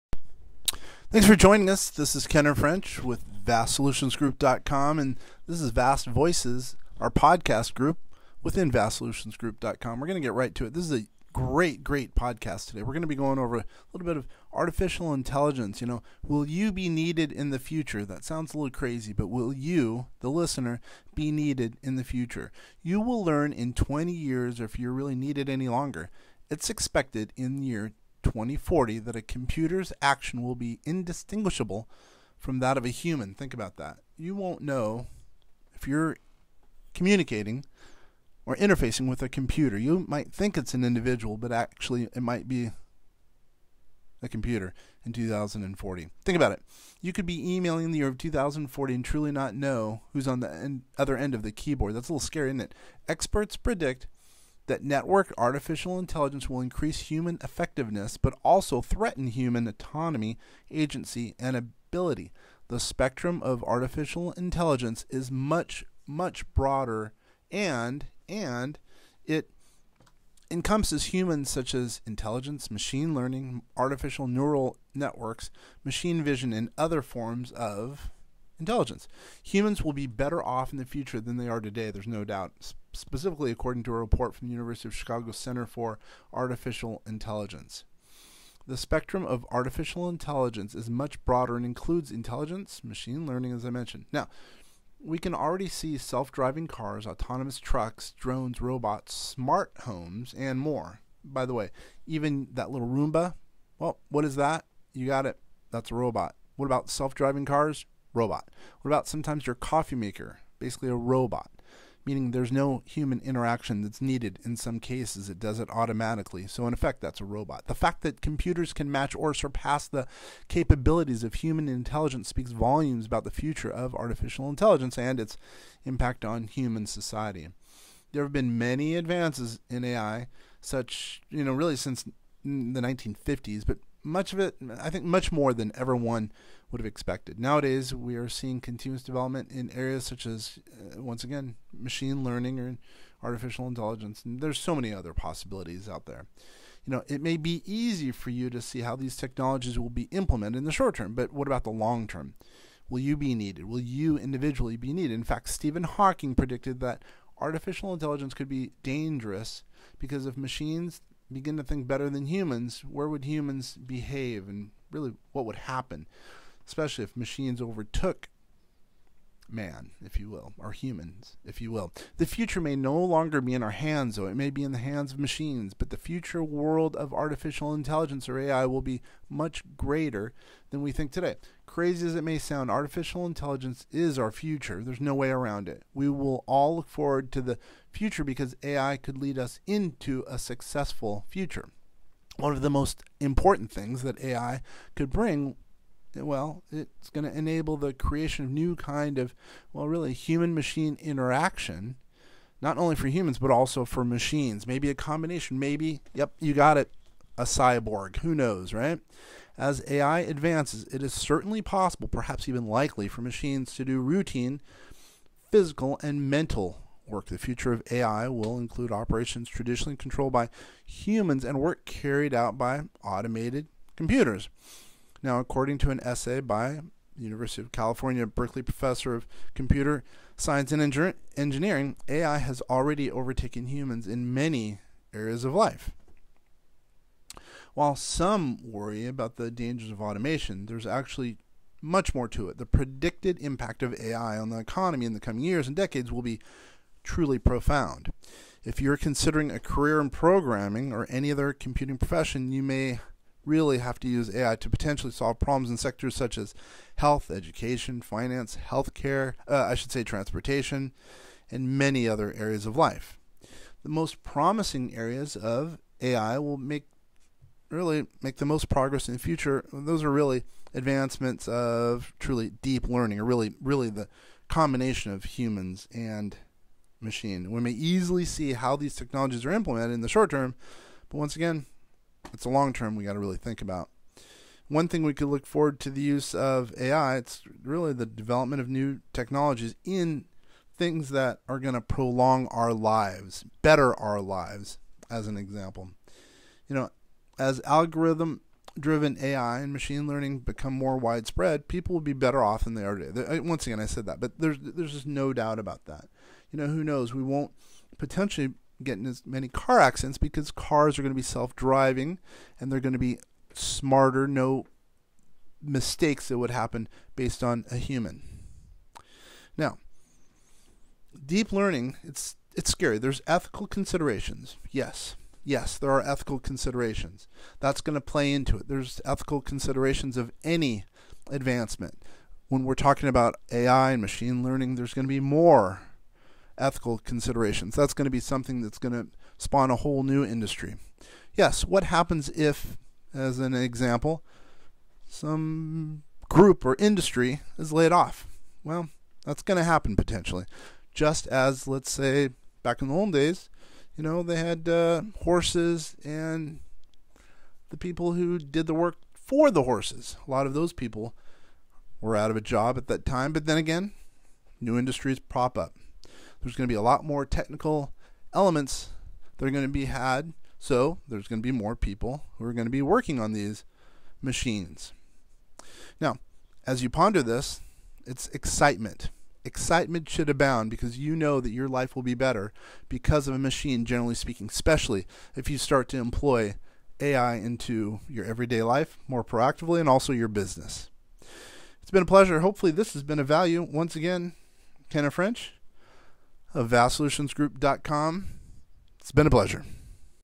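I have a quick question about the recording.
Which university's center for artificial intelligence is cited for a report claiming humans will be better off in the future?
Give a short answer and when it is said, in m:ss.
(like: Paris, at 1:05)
University of Chicago, at 1:24.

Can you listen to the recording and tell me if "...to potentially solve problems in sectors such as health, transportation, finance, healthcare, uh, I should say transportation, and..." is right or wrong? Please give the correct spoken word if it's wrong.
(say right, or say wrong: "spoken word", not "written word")
wrong: "education", not "transportation".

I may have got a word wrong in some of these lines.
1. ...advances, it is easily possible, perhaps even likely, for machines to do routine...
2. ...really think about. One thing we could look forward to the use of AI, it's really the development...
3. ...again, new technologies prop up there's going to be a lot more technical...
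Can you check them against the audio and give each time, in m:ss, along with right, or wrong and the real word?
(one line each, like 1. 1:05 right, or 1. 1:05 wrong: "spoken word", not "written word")
1. 3:30 wrong: "certainly", not "easily"
2. 4:43 right
3. 6:03 wrong: "industries", not "technologies".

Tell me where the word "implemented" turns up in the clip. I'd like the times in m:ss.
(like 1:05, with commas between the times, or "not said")
2:30, 4:39.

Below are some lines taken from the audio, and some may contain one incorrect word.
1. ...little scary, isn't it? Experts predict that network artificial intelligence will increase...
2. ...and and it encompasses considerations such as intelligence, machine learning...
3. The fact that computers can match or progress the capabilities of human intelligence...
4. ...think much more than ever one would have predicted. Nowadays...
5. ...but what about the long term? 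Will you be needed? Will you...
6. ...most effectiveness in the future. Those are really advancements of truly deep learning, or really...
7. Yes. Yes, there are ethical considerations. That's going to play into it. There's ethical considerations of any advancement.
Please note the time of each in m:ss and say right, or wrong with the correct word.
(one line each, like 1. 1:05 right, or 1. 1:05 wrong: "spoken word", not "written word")
1. 0:52 right
2. 1:07 wrong: "humans", not "considerations"
3. 1:57 wrong: "surpass", not "progress"
4. 2:14 wrong: "expected", not "predicted"
5. 2:31 right
6. 4:28 wrong: "progress", not "effectiveness"
7. 5:24 right.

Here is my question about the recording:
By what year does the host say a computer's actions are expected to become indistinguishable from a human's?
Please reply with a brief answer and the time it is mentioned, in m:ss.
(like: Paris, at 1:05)
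2040, at 0:27.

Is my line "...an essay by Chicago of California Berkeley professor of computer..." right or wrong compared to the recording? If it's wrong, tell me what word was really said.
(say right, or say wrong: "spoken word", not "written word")
wrong: "University", not "Chicago".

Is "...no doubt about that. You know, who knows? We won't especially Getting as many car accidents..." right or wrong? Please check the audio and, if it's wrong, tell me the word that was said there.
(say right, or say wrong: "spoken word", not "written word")
wrong: "potentially", not "especially".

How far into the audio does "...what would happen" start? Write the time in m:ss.
2:45.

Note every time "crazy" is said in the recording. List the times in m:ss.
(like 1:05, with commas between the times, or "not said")
0:18, 3:01.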